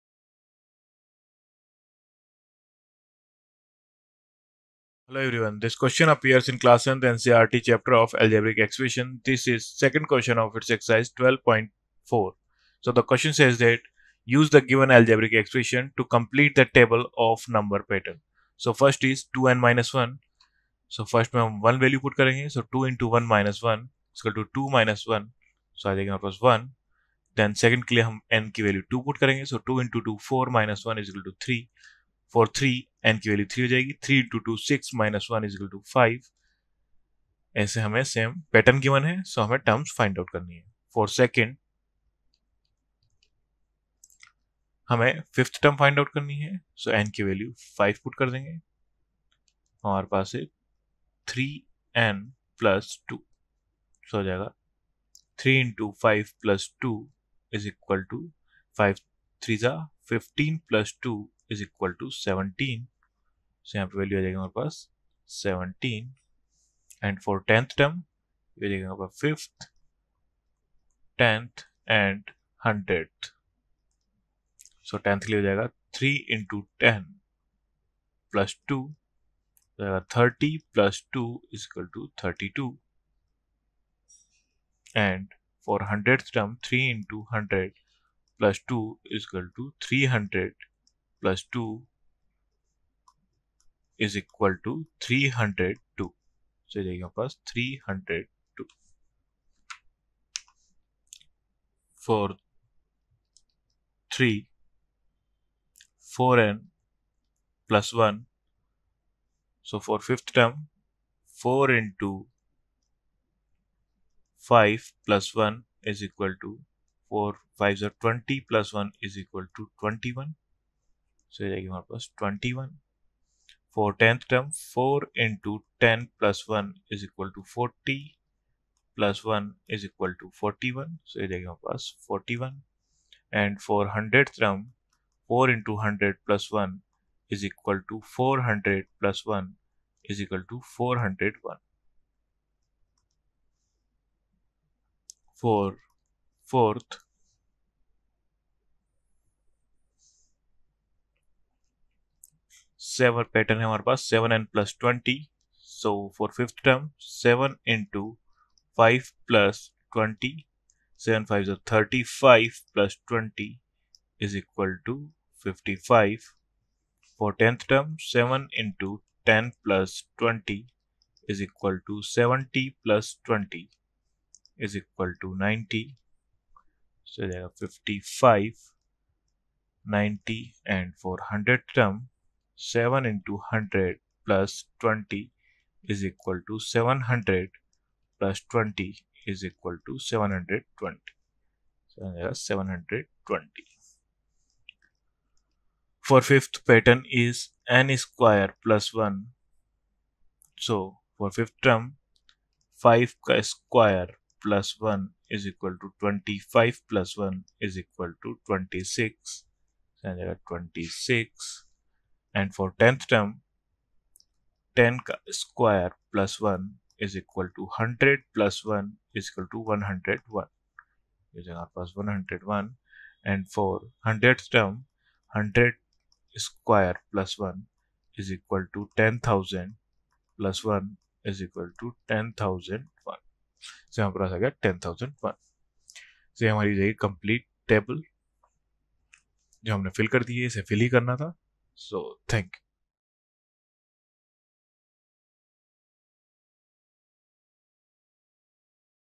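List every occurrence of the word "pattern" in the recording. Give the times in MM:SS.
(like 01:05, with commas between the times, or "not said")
00:17, 02:33, 03:16.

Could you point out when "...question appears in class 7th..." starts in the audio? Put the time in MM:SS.
00:05.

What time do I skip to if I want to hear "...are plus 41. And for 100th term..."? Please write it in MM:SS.
02:11.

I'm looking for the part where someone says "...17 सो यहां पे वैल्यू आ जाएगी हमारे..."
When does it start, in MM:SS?
01:02.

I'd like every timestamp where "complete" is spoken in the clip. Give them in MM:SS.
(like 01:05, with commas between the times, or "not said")
00:16.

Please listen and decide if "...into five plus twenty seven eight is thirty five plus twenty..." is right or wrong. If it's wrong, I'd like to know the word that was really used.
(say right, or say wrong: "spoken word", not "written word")
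wrong: "five", not "eight".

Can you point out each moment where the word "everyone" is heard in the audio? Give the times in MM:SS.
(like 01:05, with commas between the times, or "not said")
00:05.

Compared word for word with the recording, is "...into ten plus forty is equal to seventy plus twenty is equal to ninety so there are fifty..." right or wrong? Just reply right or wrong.
wrong.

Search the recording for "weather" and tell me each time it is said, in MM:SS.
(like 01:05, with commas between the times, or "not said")
not said.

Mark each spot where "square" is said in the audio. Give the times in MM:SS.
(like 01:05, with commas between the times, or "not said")
03:17, 03:23, 03:35, 03:46.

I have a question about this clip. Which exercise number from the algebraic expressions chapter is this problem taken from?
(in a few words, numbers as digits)
12.4.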